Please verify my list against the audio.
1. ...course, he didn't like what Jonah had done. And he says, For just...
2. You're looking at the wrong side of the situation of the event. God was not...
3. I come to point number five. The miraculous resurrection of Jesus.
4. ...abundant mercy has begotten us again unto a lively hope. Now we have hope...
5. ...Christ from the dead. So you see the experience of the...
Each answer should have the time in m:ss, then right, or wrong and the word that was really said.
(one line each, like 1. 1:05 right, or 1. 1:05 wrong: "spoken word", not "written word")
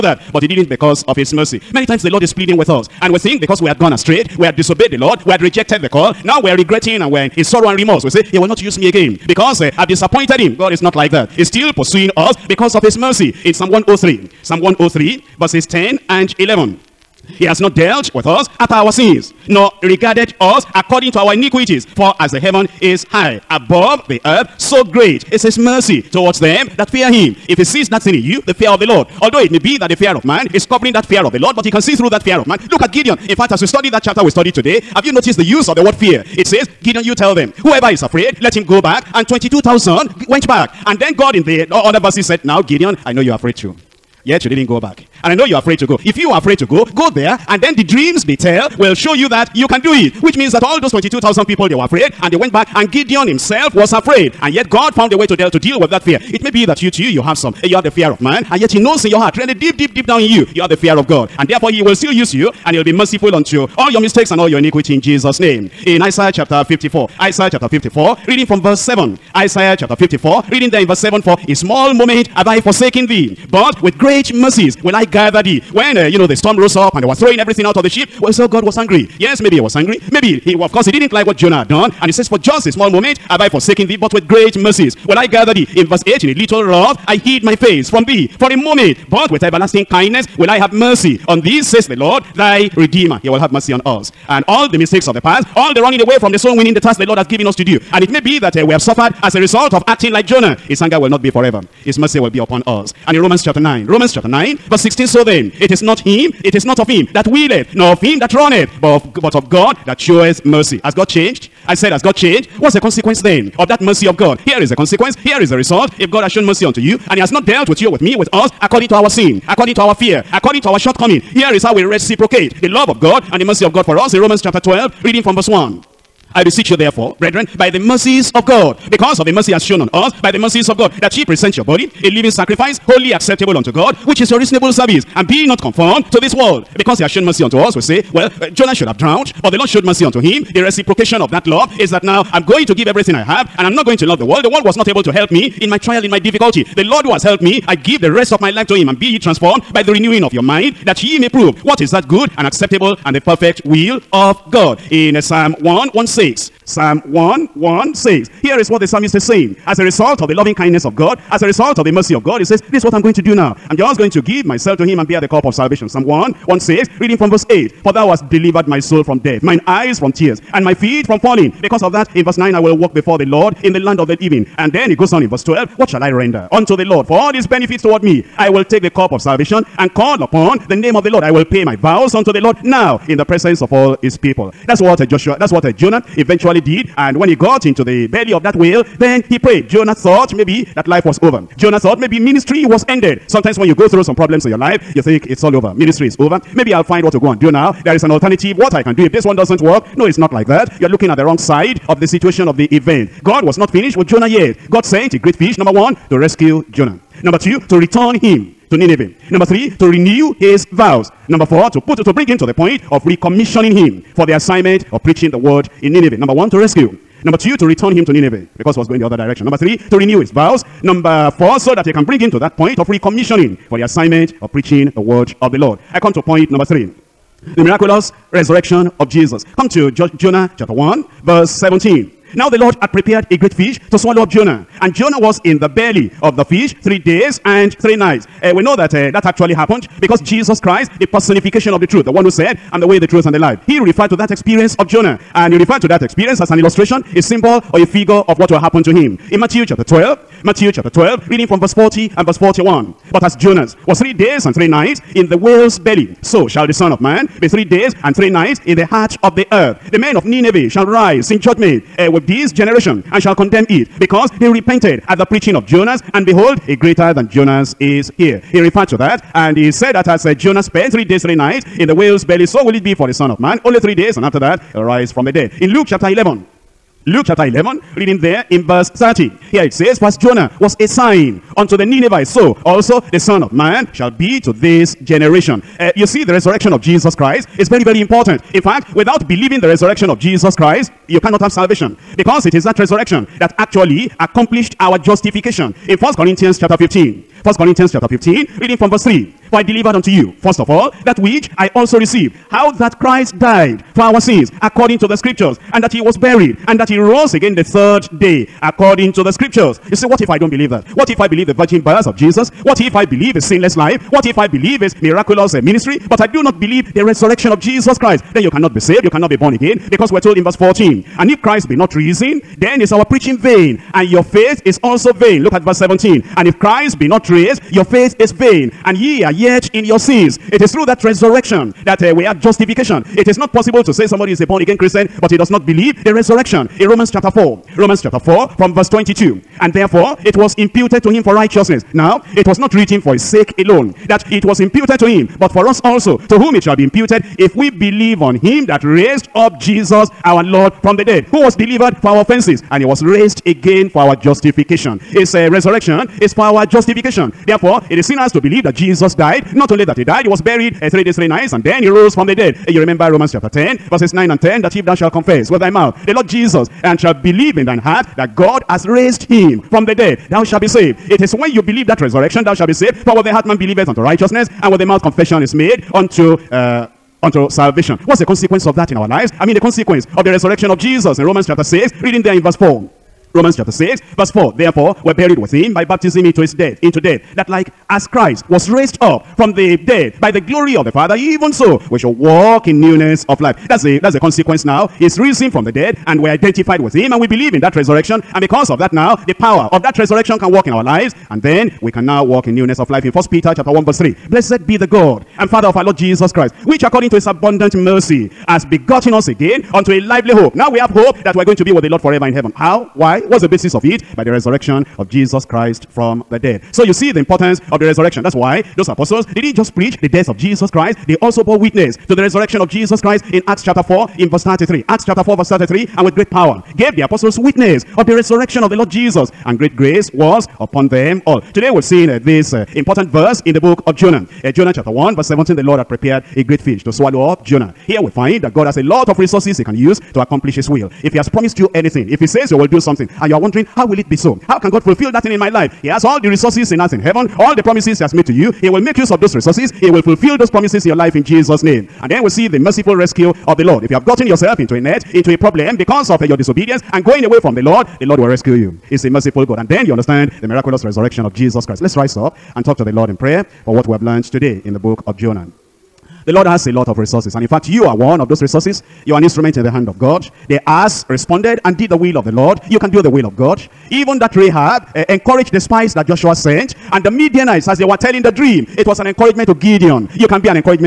1. 1:20 right
2. 3:20 right
3. 3:45 wrong: "three", not "five"
4. 6:47 right
5. 6:55 wrong: "importance", not "experience".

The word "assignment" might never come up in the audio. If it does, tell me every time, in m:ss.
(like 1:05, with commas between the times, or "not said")
3:34, 3:43.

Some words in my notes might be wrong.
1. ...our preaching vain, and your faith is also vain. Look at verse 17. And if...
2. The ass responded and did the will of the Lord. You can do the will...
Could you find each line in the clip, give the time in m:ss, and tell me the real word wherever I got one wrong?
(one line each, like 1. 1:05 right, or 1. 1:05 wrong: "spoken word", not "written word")
1. 5:22 right
2. 7:50 right.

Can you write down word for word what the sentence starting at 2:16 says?
Because he has shown mercy unto us, we say, well, uh, Jonah should have drowned, but the Lord showed mercy unto him.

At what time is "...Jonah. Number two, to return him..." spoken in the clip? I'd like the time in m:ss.
3:26.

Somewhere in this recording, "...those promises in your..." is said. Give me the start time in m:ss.
7:30.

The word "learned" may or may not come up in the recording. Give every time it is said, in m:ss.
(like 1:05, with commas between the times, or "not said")
7:44.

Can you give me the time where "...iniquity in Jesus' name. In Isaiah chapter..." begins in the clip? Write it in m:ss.
1:04.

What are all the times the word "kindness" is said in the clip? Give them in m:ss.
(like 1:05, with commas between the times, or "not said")
1:29, 2:40.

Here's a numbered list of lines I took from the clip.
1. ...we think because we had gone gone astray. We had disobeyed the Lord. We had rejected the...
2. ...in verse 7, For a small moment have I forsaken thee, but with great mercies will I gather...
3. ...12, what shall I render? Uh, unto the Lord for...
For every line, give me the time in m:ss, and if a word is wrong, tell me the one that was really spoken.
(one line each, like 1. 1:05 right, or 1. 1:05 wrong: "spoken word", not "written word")
1. 0:03 right
2. 1:10 right
3. 2:55 right.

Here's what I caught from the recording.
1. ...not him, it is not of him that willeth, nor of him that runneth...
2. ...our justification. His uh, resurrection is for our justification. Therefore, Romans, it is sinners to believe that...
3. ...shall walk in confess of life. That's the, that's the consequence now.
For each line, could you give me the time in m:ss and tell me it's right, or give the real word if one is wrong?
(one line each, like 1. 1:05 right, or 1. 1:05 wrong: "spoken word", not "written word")
1. 1:45 right
2. 5:53 wrong: "Therefore", not "Romans"
3. 6:31 wrong: "newness", not "confess".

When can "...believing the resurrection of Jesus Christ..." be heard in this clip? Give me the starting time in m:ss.
4:49.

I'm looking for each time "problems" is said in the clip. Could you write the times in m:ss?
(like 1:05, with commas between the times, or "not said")
3:14, 7:35.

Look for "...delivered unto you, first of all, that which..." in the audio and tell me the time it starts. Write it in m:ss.
4:59.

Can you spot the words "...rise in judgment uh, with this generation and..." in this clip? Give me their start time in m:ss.
4:20.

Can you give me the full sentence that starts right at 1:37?
And it may be that uh, we have suffered as a result of acting like Jonah.